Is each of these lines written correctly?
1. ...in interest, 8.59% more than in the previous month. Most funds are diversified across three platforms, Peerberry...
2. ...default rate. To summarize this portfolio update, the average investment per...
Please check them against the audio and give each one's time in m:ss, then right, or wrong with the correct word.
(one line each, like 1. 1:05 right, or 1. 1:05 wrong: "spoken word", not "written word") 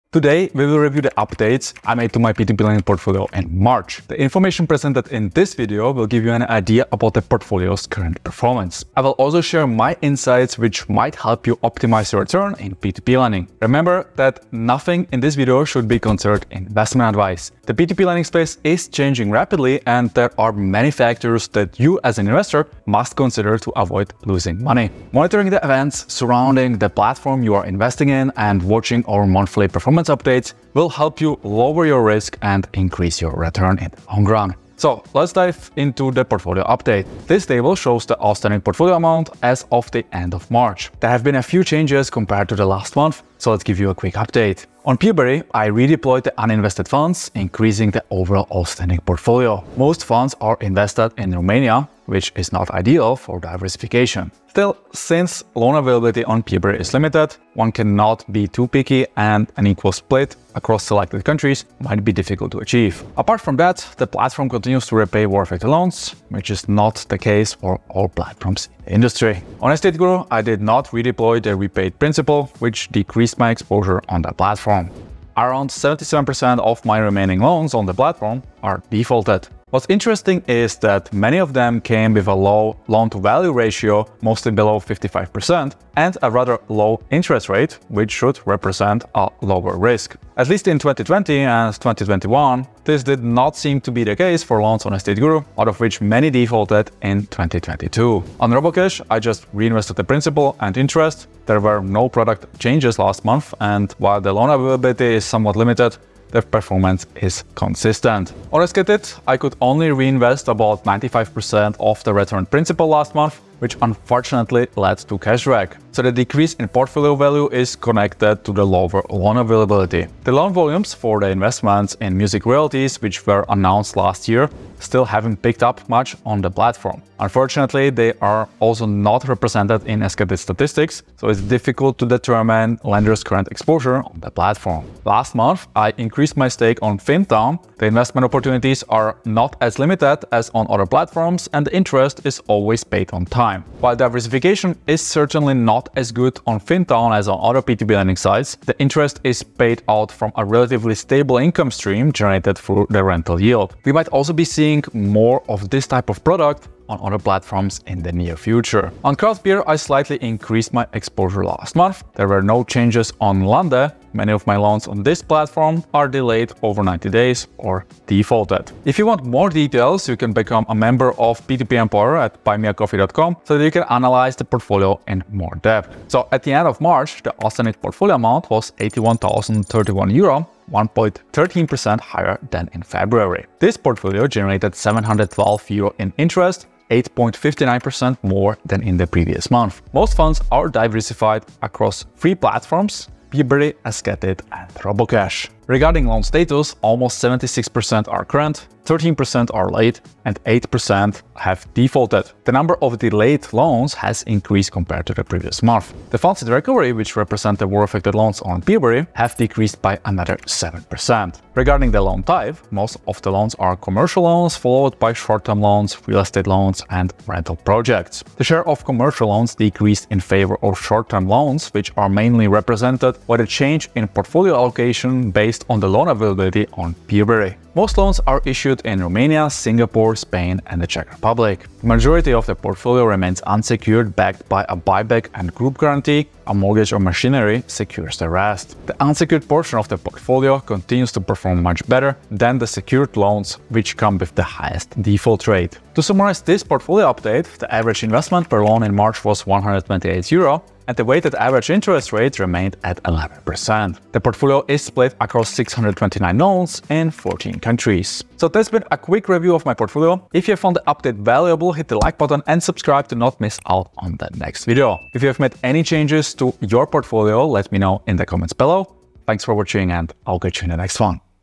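1. 3:05 right
2. 4:05 right.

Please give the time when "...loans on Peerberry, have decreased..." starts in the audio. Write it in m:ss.
3:28.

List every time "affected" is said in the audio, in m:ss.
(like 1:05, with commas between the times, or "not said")
1:05, 3:27.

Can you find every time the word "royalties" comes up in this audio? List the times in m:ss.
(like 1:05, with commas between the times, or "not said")
2:02.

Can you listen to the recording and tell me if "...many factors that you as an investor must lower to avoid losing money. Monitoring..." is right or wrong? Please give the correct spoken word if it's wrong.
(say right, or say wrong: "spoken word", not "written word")
wrong: "consider", not "lower".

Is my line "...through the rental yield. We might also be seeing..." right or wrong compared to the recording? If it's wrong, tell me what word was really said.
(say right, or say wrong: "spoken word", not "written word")
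right.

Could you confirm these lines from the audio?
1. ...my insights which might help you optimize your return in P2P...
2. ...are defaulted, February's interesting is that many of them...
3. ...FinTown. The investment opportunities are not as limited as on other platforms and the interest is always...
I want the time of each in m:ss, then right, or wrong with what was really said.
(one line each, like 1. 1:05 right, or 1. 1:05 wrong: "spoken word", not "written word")
1. 0:09 right
2. 1:18 wrong: "What", not "February"
3. 2:16 right.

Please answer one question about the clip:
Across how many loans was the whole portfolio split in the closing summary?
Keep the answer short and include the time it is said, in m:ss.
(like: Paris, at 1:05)
629, at 4:15.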